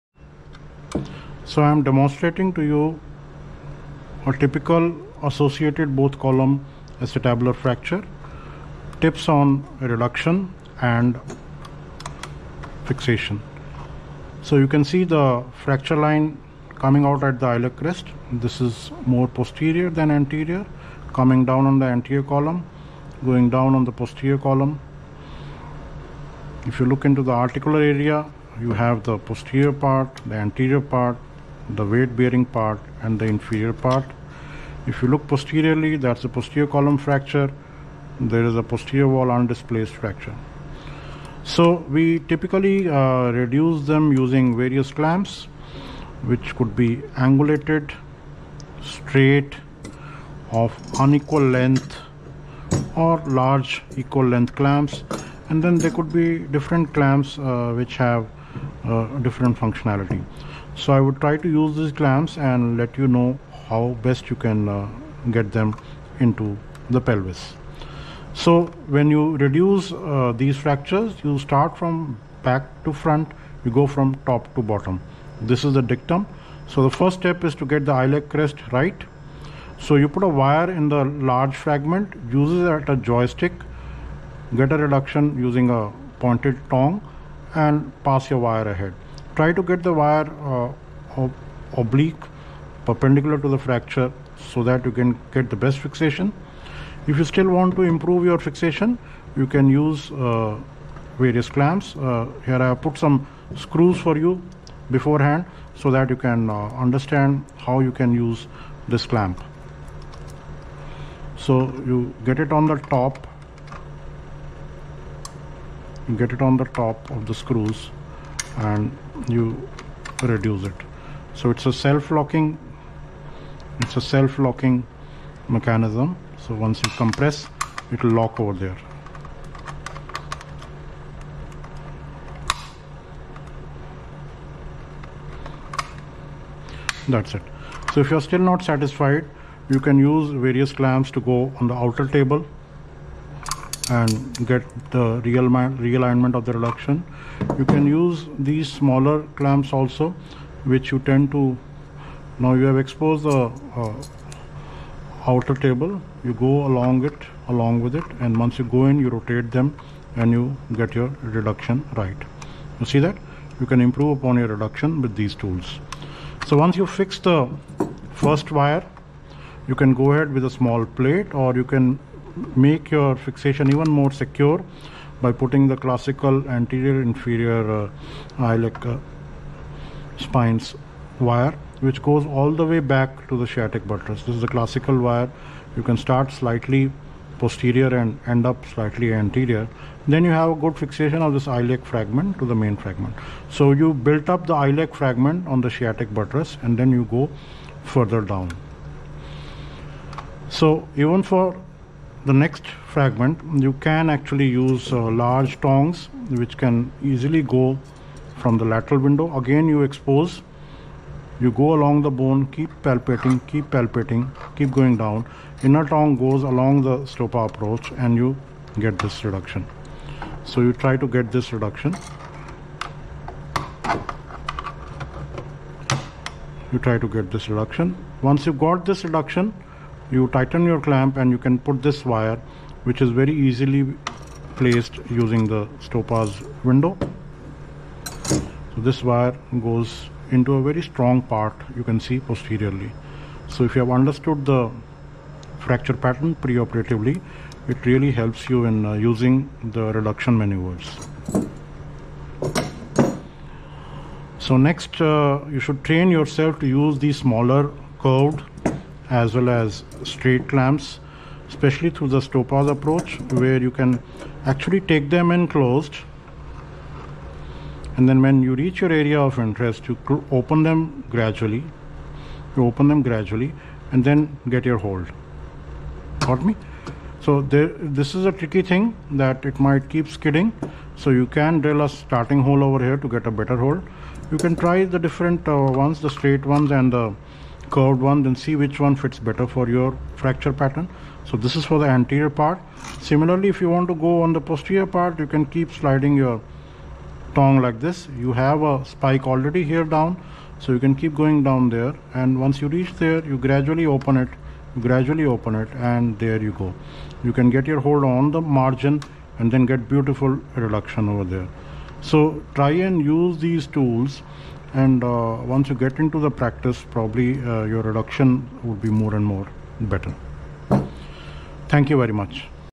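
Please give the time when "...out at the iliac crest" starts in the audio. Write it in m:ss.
0:17.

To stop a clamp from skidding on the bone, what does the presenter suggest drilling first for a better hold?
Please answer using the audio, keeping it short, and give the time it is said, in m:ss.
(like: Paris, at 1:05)
a starting hole, at 4:41.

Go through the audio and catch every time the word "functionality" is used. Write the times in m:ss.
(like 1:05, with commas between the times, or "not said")
0:59.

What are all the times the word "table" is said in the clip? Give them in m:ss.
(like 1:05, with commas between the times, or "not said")
2:22, 2:35.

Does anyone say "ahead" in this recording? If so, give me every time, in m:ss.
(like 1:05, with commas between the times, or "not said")
1:28, 2:50.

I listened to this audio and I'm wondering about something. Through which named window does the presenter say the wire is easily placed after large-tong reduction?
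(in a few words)
Stoppa's window.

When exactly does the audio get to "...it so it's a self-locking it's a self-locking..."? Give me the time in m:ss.
2:00.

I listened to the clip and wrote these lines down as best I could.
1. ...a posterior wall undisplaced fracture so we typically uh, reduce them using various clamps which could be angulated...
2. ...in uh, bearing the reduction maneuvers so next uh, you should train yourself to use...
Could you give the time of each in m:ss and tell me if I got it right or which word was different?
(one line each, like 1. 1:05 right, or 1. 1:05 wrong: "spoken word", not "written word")
1. 0:38 right
2. 4:08 wrong: "using", not "bearing".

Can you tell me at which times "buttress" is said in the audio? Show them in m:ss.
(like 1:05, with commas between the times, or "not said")
3:03, 3:16.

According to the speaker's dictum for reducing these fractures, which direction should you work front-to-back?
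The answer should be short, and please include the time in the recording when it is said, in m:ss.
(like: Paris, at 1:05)
back to front, at 1:12.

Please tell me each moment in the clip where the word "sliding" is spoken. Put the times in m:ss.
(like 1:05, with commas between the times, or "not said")
4:55.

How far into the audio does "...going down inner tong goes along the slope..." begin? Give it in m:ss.
3:34.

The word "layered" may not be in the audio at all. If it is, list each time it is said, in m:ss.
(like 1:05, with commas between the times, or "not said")
not said.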